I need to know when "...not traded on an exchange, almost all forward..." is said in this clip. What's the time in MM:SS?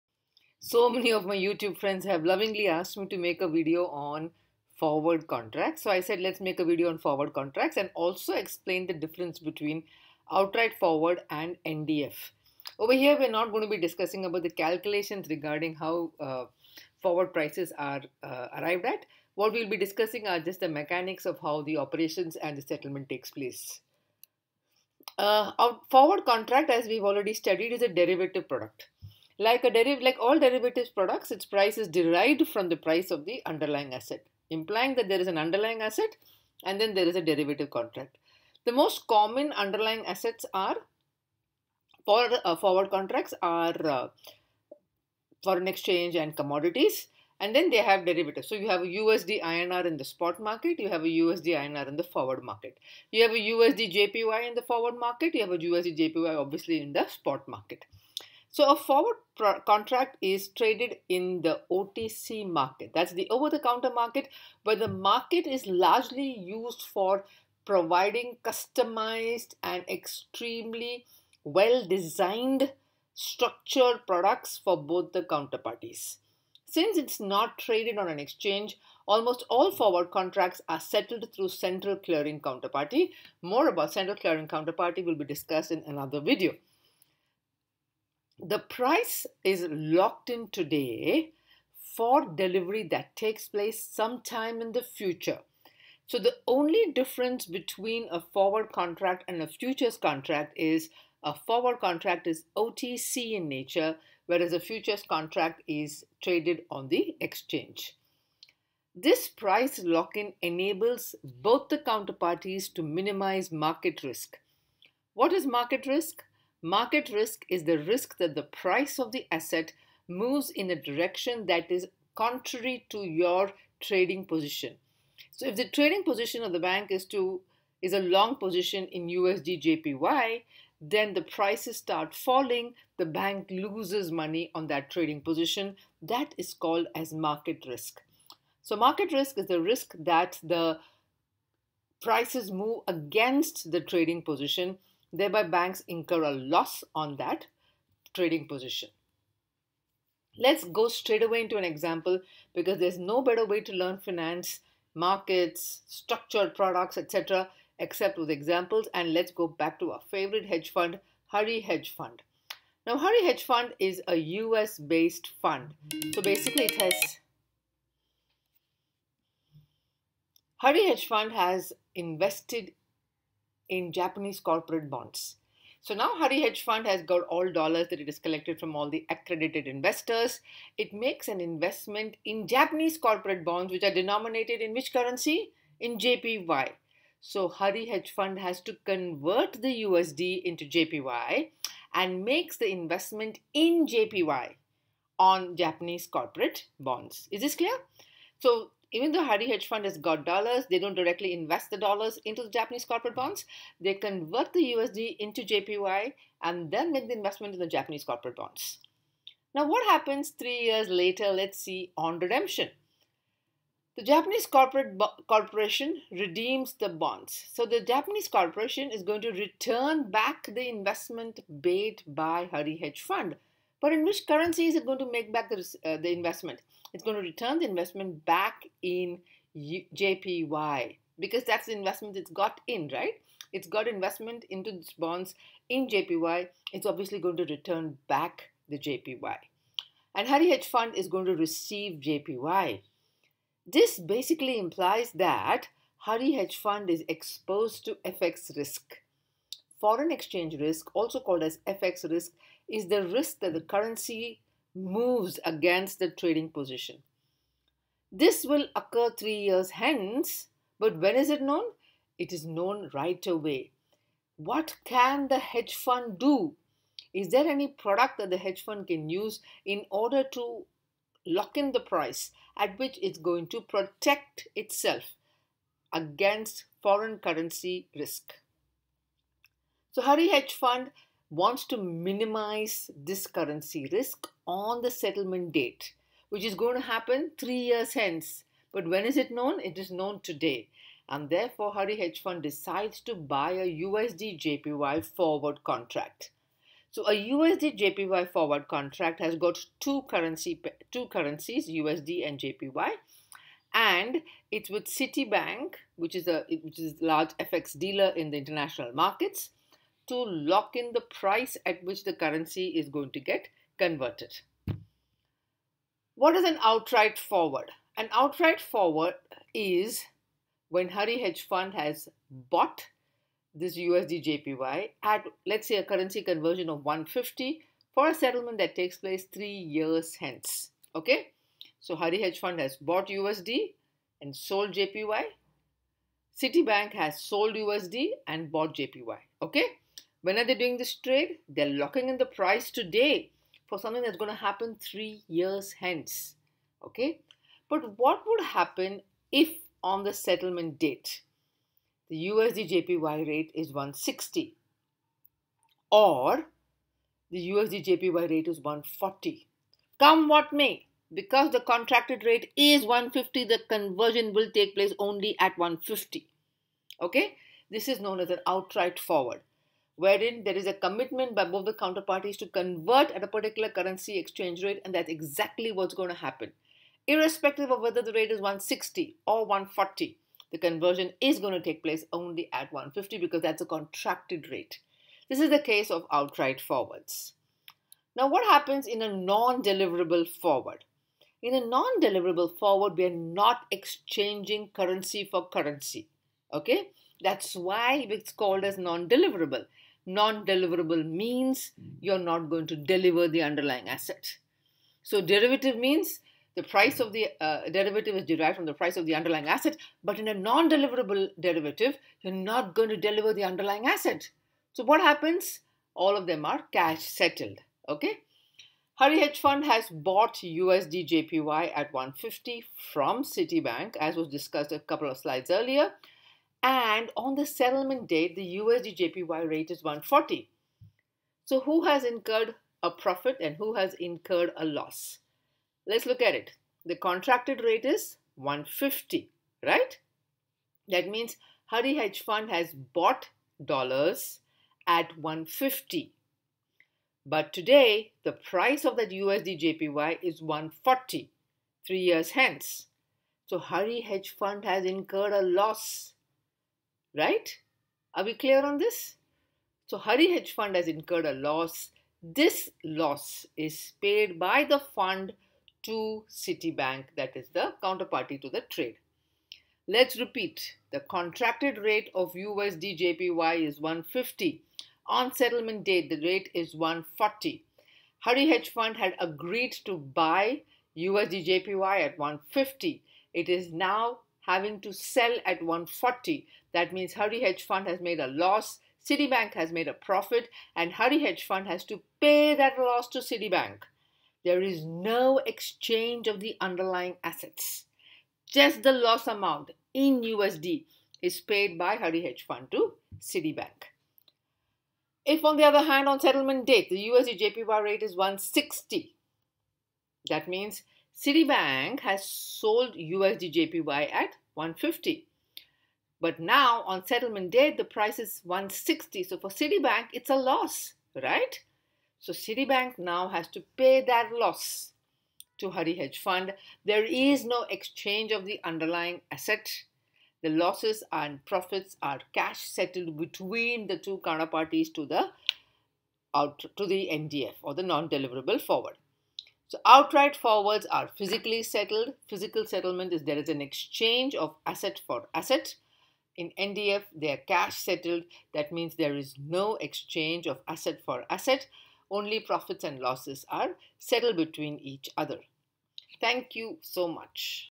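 01:17.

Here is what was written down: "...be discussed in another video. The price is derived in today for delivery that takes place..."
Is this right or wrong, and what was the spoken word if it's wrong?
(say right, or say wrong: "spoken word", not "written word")
wrong: "locked", not "derived".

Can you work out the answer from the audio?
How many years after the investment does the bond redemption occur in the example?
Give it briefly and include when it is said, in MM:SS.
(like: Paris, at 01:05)
3, at 03:30.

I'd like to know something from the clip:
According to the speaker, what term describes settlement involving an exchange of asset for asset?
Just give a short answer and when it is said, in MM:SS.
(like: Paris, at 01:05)
physical settlement, at 09:02.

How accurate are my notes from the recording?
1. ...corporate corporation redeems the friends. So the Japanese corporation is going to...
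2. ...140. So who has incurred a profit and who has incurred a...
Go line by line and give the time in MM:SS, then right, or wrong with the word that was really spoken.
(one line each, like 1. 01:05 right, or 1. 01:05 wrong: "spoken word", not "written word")
1. 03:34 wrong: "bonds", not "friends"
2. 07:09 right.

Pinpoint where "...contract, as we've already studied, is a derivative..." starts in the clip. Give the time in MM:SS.
00:26.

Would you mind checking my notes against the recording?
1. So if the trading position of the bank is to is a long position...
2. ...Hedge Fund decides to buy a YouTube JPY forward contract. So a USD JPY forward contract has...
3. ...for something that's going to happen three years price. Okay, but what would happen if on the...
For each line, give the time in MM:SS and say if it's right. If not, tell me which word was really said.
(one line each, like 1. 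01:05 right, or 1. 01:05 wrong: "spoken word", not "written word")
1. 02:05 right
2. 04:51 wrong: "USD", not "YouTube"
3. 05:43 wrong: "hence", not "price".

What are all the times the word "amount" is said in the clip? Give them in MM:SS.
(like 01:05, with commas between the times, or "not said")
08:19.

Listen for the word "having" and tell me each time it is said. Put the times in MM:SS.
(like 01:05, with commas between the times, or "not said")
08:04.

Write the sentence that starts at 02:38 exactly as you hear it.
And let's go back to our favorite hedge fund, Hari Hedge Fund.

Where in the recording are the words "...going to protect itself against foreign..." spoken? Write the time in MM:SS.
04:33.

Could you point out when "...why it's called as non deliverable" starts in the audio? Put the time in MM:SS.
06:37.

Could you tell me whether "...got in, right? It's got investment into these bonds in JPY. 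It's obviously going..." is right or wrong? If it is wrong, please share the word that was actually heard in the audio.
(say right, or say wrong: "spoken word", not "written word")
right.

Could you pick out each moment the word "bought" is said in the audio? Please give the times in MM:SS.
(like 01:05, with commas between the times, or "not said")
05:22, 05:32, 05:38, 06:59, 07:22.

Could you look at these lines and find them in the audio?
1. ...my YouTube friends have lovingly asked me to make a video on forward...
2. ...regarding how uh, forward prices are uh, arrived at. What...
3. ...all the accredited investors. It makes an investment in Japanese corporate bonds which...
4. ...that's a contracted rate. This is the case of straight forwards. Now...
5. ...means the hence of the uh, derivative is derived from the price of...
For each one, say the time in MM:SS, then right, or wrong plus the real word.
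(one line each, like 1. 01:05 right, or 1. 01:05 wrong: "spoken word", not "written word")
1. 00:01 right
2. 00:15 right
3. 02:58 right
4. 06:23 wrong: "outright", not "straight"
5. 06:45 wrong: "price", not "hence".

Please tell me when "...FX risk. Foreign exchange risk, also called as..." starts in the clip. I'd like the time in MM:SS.
04:08.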